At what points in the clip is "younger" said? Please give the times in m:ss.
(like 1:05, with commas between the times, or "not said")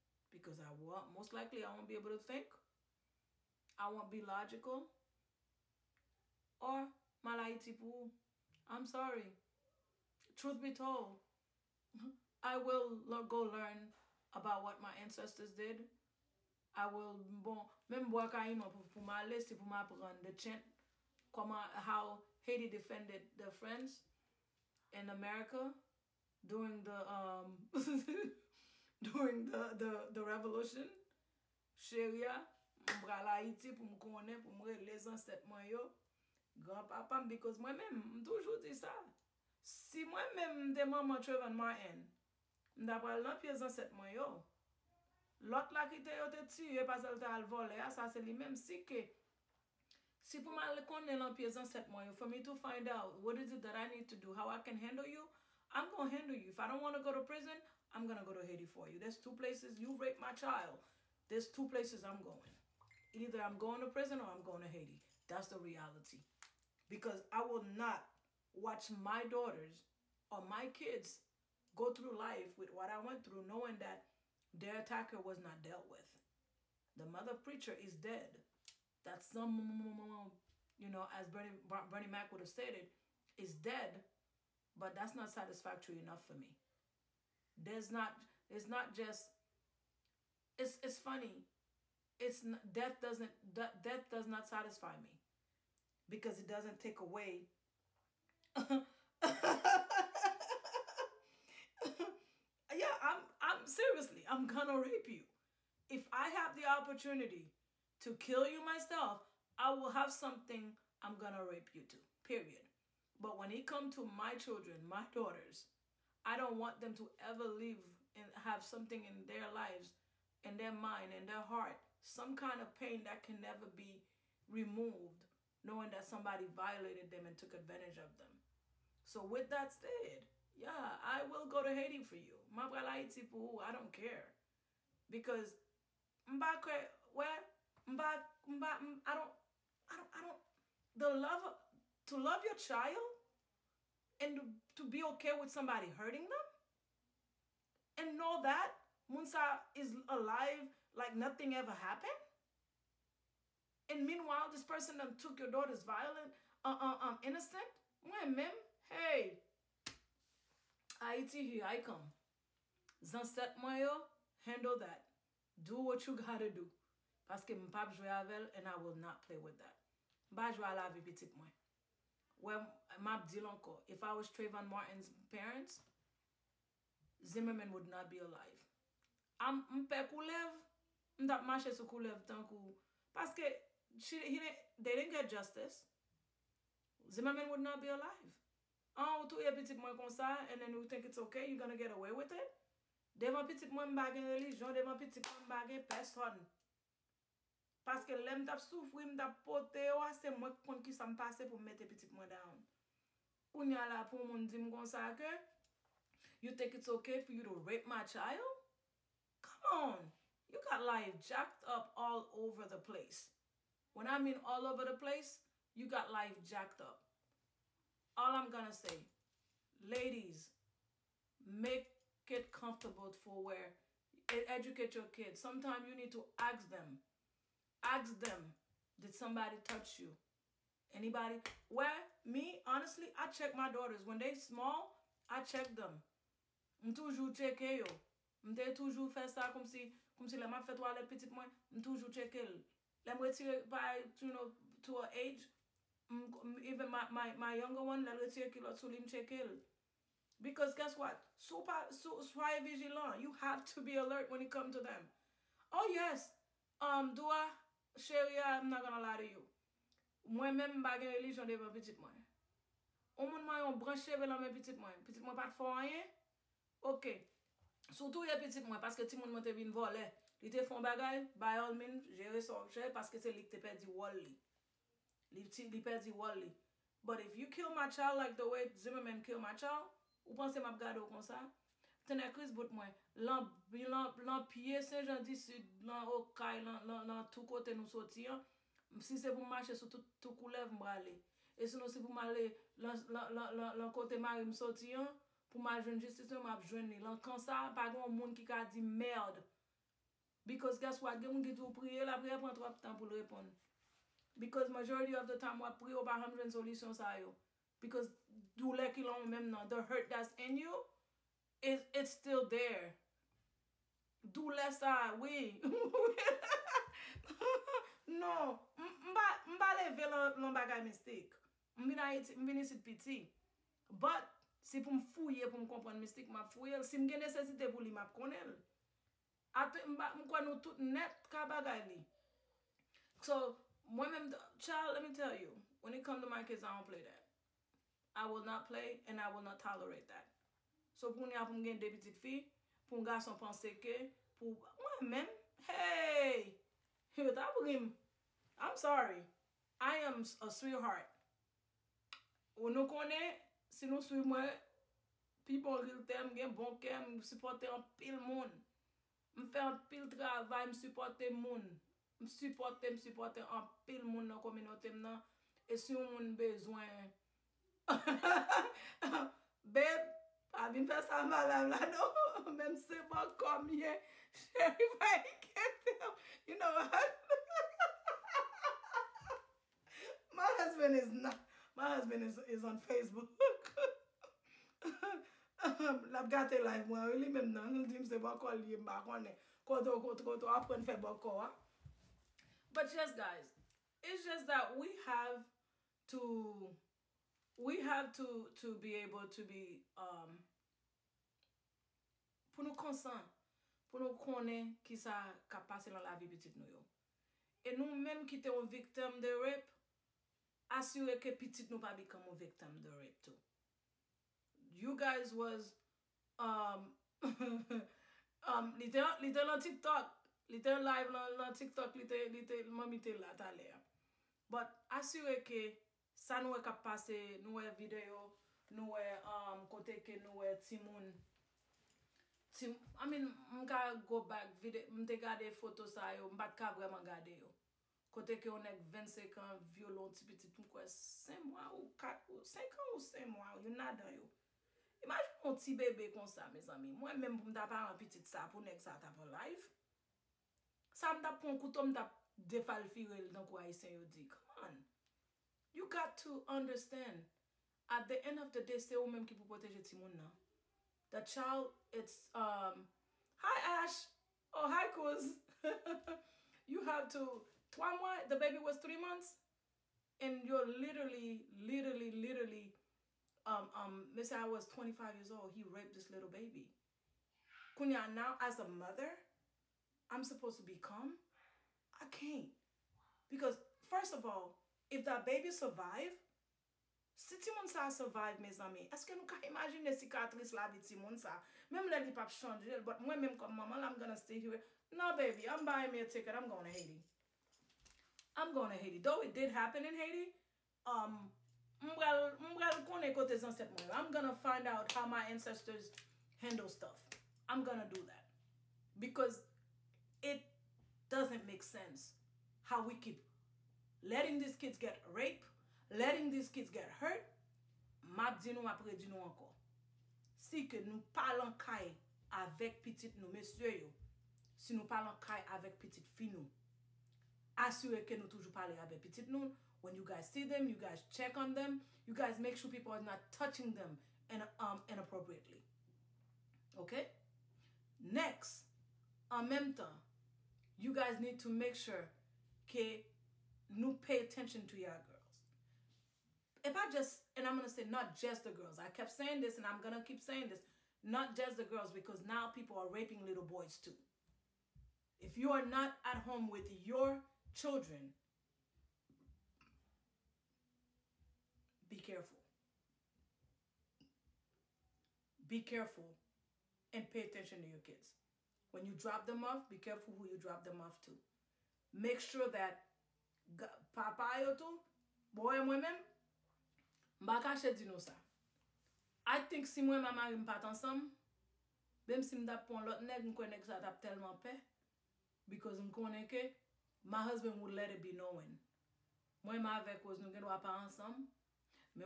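4:07.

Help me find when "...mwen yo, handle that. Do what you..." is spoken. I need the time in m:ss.
2:43.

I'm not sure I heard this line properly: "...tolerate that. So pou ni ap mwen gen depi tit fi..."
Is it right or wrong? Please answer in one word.
right.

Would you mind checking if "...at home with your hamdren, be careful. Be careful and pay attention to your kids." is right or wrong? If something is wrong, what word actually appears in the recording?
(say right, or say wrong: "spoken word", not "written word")
wrong: "children", not "hamdren".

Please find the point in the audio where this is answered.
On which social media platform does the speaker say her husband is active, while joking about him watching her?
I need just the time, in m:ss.
6:22.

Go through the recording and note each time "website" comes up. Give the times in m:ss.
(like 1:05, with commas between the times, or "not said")
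not said.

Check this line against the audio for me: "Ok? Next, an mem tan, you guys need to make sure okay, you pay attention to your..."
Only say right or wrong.
right.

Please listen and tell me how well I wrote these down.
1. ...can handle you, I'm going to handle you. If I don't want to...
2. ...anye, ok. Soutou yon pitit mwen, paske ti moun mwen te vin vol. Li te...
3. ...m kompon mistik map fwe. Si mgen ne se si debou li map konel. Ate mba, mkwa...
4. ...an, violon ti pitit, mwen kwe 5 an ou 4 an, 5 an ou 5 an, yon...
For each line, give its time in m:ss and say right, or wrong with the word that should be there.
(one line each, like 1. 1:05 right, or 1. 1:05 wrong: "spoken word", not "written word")
1. 0:54 right
2. 4:25 right
3. 5:25 right
4. 7:19 right.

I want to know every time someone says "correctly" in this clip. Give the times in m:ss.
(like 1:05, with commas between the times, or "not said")
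not said.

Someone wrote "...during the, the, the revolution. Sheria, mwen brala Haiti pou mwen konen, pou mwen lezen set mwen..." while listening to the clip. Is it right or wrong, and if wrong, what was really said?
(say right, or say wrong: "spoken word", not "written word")
right.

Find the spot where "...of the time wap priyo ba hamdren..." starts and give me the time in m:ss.
5:05.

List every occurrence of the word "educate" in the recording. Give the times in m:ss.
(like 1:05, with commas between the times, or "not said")
3:44.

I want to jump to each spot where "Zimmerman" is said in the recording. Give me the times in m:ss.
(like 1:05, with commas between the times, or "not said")
2:57, 3:07, 4:38.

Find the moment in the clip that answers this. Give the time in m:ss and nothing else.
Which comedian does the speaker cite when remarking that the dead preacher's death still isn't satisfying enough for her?
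1:21.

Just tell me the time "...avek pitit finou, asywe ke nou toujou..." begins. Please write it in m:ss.
8:45.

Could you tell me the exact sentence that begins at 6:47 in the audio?
E nou men ki te ou viktem de rep, asyou e ke pitit nou pa bikam ou viktem de rep tou.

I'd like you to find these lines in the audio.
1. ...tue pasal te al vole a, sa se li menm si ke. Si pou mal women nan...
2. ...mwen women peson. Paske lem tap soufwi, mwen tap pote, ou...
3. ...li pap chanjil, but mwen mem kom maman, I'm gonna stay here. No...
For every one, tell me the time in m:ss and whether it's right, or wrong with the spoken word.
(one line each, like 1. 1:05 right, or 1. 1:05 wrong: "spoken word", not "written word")
1. 0:46 wrong: "konnen", not "women"
2. 3:15 wrong: "bagen", not "women"
3. 8:12 right.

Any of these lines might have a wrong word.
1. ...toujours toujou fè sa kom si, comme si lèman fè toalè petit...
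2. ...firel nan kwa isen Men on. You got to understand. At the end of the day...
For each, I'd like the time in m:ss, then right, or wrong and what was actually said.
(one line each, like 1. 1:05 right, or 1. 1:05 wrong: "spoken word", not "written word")
1. 3:58 right
2. 7:32 wrong: "Come", not "Men".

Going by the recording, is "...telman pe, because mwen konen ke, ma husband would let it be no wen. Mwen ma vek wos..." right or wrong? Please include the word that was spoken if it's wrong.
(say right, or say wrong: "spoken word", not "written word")
right.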